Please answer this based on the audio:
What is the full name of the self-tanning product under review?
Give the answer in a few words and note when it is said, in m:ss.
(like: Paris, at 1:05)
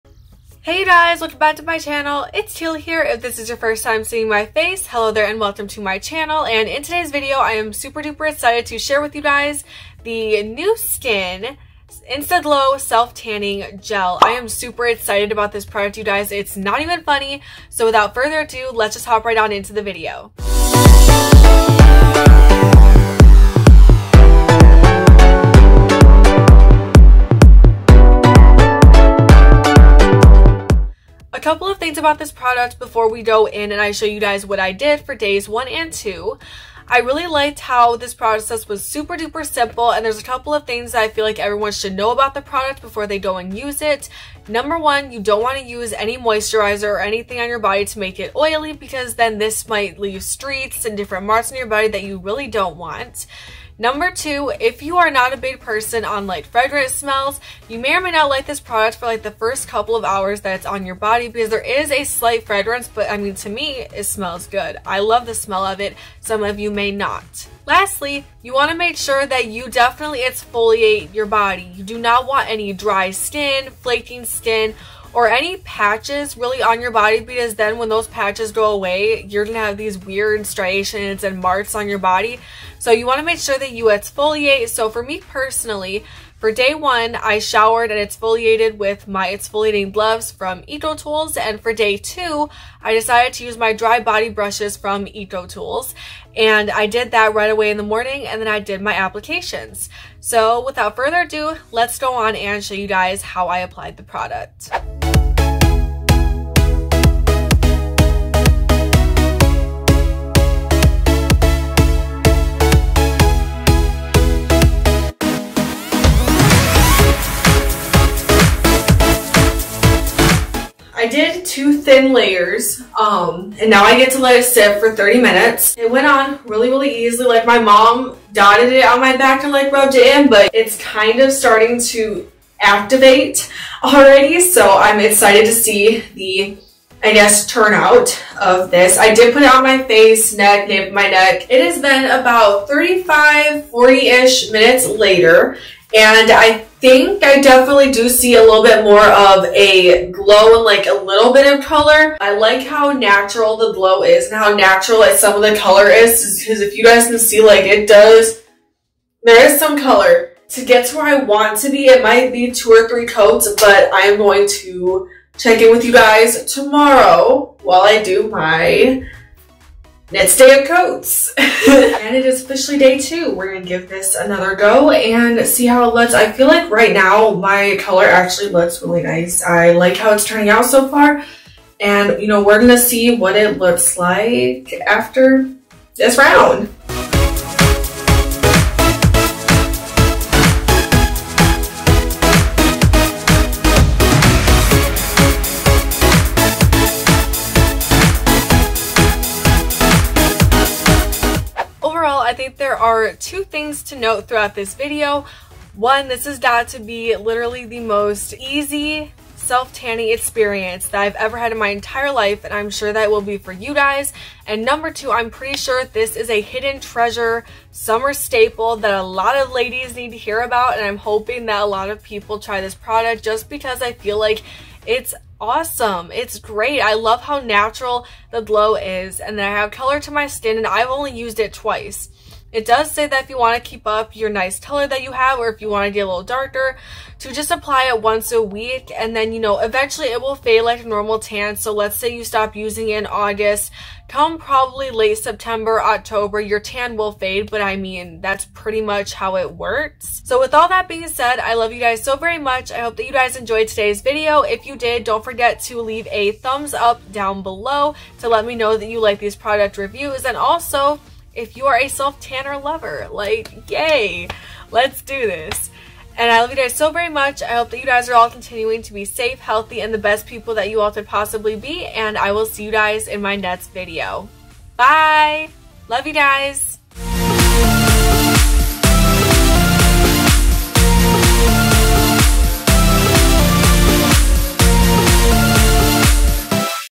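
NuSkin Instaglow Self Tanning Gel, at 0:10.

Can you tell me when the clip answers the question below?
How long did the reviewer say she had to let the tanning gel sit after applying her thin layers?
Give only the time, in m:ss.
2:04.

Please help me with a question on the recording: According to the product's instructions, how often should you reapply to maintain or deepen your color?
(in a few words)
once a week.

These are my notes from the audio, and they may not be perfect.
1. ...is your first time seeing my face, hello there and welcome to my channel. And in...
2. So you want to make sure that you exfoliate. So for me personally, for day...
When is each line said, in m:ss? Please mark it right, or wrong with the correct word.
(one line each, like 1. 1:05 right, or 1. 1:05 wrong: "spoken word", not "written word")
1. 0:03 right
2. 1:22 right.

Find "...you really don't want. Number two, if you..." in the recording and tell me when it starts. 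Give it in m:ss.
0:52.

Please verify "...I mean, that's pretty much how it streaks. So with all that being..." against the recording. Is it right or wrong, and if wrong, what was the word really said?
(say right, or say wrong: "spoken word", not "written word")
wrong: "works", not "streaks".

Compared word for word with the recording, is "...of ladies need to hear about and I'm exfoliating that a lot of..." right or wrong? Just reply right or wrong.
wrong.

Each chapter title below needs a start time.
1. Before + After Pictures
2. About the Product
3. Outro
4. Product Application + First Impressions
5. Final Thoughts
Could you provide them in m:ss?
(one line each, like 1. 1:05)
1. 3:52
2. 0:30
3. 4:36
4. 1:45
5. 3:21.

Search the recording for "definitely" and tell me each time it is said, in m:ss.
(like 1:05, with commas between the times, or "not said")
1:09, 2:27.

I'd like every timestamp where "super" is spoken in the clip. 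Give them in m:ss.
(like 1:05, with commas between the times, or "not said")
0:07, 0:14, 0:38.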